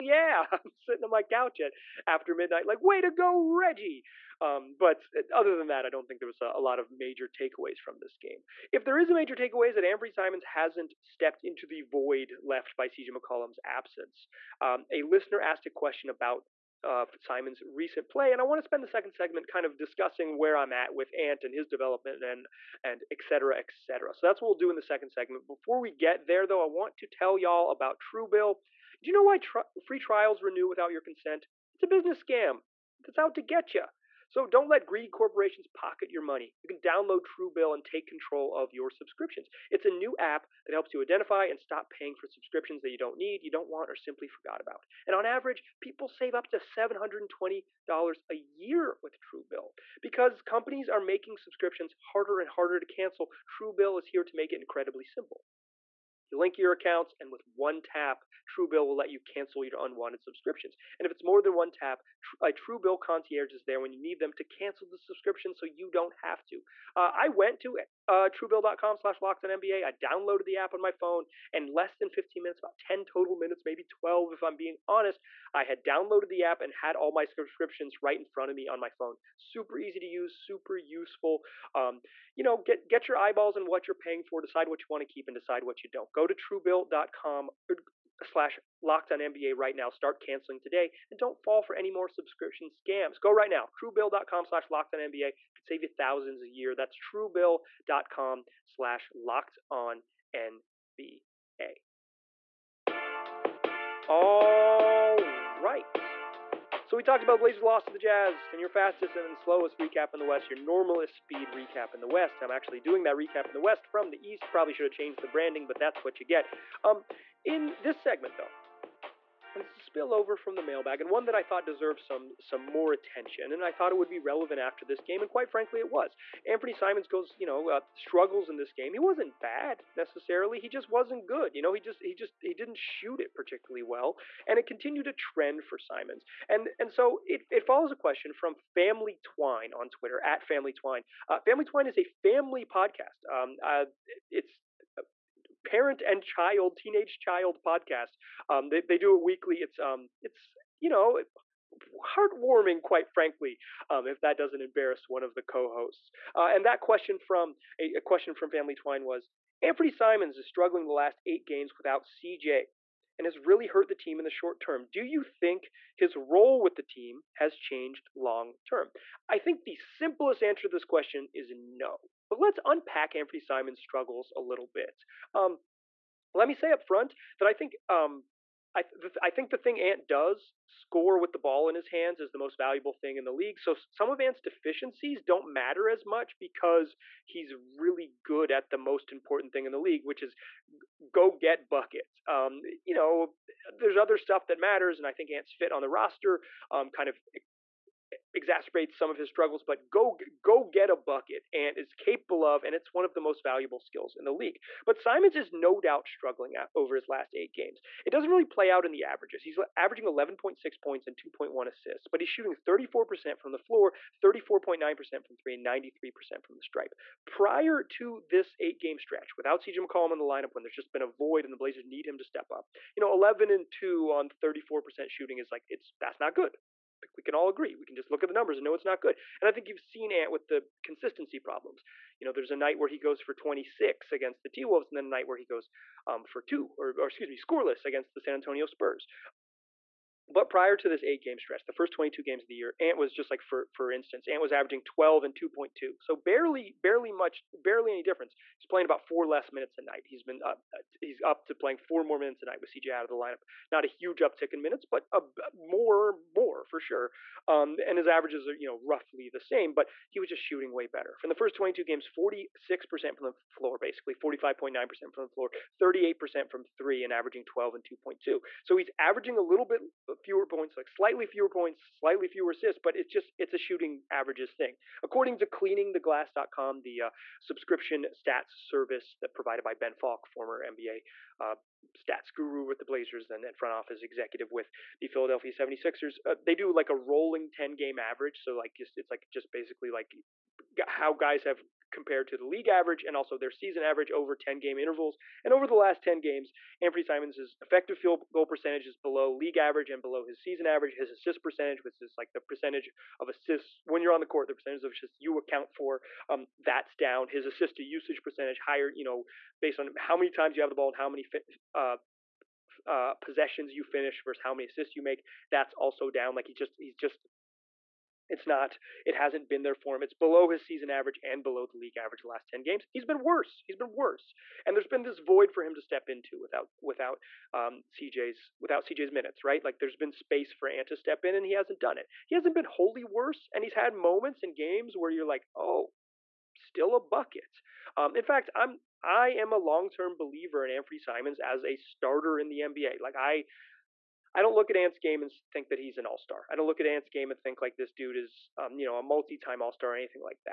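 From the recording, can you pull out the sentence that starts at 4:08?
He's playing about four less minutes a night.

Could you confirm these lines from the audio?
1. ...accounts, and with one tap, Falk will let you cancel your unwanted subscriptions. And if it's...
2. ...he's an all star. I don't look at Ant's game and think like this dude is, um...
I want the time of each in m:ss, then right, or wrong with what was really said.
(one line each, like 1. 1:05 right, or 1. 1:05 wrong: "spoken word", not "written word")
1. 0:56 wrong: "Truebill", not "Falk"
2. 5:45 right.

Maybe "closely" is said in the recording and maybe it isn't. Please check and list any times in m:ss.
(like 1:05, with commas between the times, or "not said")
not said.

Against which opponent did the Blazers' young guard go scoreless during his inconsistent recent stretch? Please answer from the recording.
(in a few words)
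San Antonio Spurs.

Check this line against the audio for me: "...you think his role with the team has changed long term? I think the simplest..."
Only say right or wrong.
right.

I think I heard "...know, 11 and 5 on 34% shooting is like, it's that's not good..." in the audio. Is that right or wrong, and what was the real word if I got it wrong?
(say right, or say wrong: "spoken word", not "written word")
wrong: "2", not "5".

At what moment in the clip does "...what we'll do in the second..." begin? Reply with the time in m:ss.
0:24.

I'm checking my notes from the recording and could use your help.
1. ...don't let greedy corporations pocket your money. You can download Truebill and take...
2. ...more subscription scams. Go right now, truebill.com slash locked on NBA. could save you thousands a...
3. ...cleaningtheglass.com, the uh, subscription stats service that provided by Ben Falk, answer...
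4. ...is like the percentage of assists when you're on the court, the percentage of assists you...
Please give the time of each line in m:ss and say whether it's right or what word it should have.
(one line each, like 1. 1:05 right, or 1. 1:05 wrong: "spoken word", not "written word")
1. 0:34 right
2. 1:31 right
3. 4:35 wrong: "former", not "answer"
4. 5:02 right.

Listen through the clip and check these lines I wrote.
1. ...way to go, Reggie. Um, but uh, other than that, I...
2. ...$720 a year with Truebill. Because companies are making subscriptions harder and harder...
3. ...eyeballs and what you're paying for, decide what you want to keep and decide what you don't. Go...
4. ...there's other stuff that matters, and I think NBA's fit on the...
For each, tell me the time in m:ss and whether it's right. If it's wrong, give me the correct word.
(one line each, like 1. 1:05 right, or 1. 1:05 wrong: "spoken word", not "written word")
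1. 0:02 right
2. 0:46 right
3. 1:23 right
4. 3:13 wrong: "Ant", not "NBA".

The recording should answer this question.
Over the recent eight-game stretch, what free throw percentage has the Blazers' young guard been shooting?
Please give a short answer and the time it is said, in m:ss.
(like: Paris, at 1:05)
93%, at 3:35.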